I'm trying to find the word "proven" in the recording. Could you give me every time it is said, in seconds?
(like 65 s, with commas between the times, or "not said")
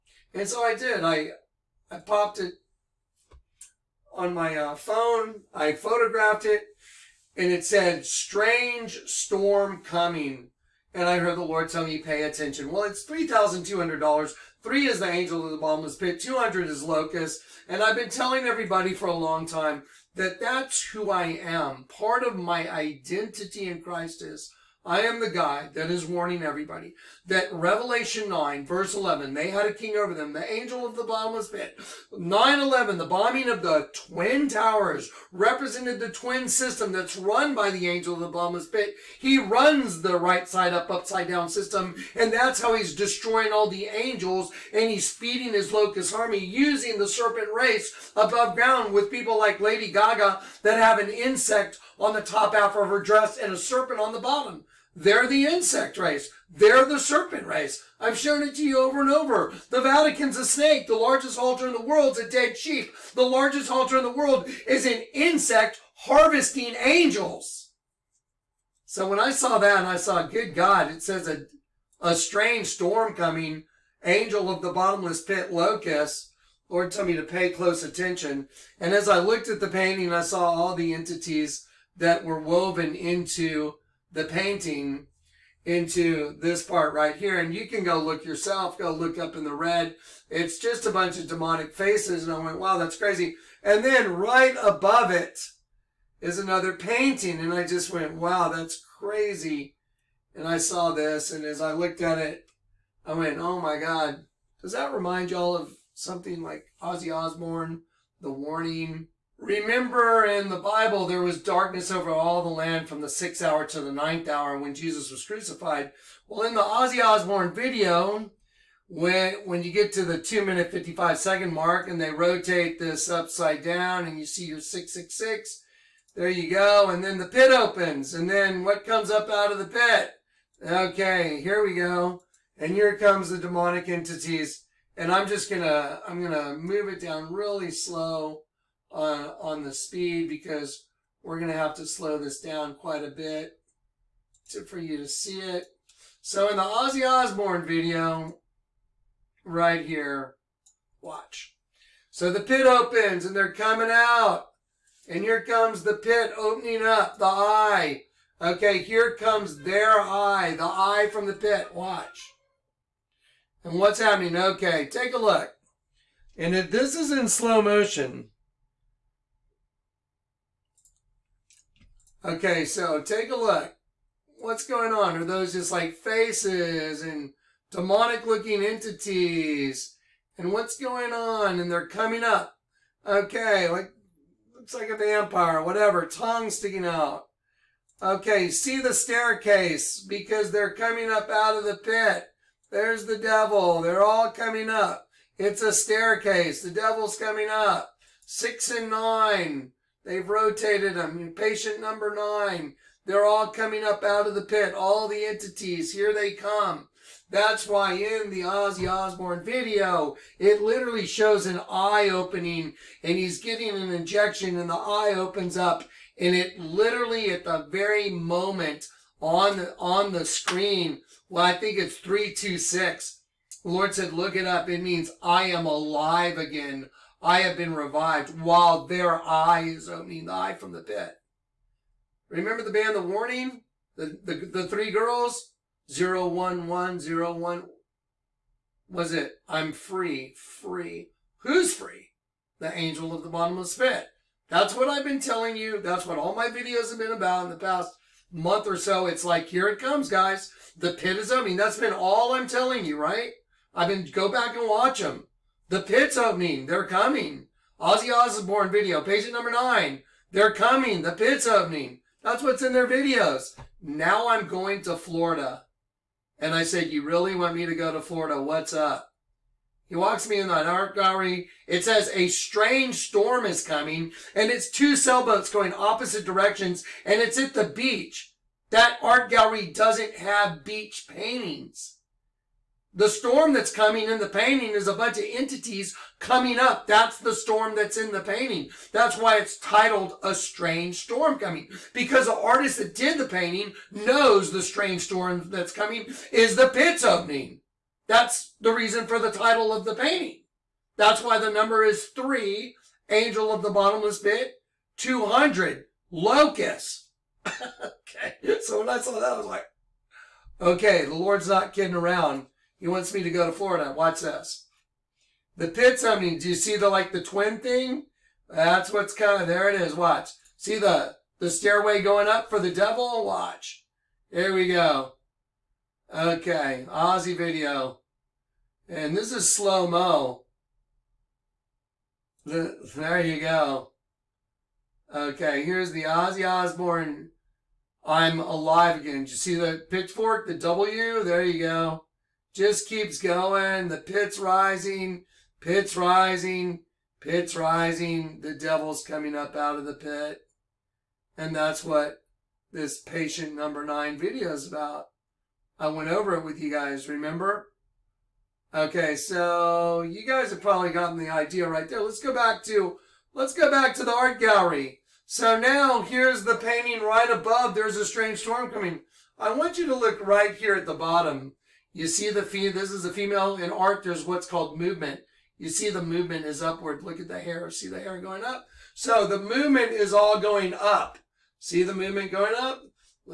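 not said.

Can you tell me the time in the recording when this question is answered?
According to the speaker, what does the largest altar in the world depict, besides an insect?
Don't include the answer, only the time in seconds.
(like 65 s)
62 s.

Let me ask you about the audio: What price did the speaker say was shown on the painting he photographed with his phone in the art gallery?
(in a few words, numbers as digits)
$3,200.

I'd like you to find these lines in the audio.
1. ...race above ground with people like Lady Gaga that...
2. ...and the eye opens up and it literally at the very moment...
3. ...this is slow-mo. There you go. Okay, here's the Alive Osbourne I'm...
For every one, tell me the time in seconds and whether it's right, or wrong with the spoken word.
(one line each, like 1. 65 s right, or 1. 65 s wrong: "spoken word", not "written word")
1. 47 s right
2. 214 s right
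3. 329 s wrong: "Ozzy", not "Alive".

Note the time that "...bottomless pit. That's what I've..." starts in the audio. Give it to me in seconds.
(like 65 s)
243 s.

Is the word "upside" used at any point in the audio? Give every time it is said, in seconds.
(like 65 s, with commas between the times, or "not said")
40 s, 123 s.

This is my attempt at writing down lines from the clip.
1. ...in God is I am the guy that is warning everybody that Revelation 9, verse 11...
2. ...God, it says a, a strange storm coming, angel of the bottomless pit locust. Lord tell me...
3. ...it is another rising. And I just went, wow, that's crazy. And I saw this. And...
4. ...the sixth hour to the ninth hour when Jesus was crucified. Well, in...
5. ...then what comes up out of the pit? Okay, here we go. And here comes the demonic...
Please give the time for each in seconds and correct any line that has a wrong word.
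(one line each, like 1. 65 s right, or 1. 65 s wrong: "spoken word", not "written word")
1. 23 s wrong: "Christ", not "God"
2. 70 s right
3. 95 s wrong: "painting", not "rising"
4. 113 s right
5. 128 s right.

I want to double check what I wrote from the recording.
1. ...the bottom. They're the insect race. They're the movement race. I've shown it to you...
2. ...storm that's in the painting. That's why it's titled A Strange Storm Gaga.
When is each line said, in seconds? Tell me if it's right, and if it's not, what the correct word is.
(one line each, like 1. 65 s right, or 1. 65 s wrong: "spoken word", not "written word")
1. 54 s wrong: "serpent", not "movement"
2. 287 s wrong: "Coming", not "Gaga".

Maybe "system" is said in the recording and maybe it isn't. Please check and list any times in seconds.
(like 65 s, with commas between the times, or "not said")
36 s, 41 s.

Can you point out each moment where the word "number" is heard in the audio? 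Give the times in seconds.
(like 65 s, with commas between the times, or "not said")
201 s, 259 s, 301 s, 353 s.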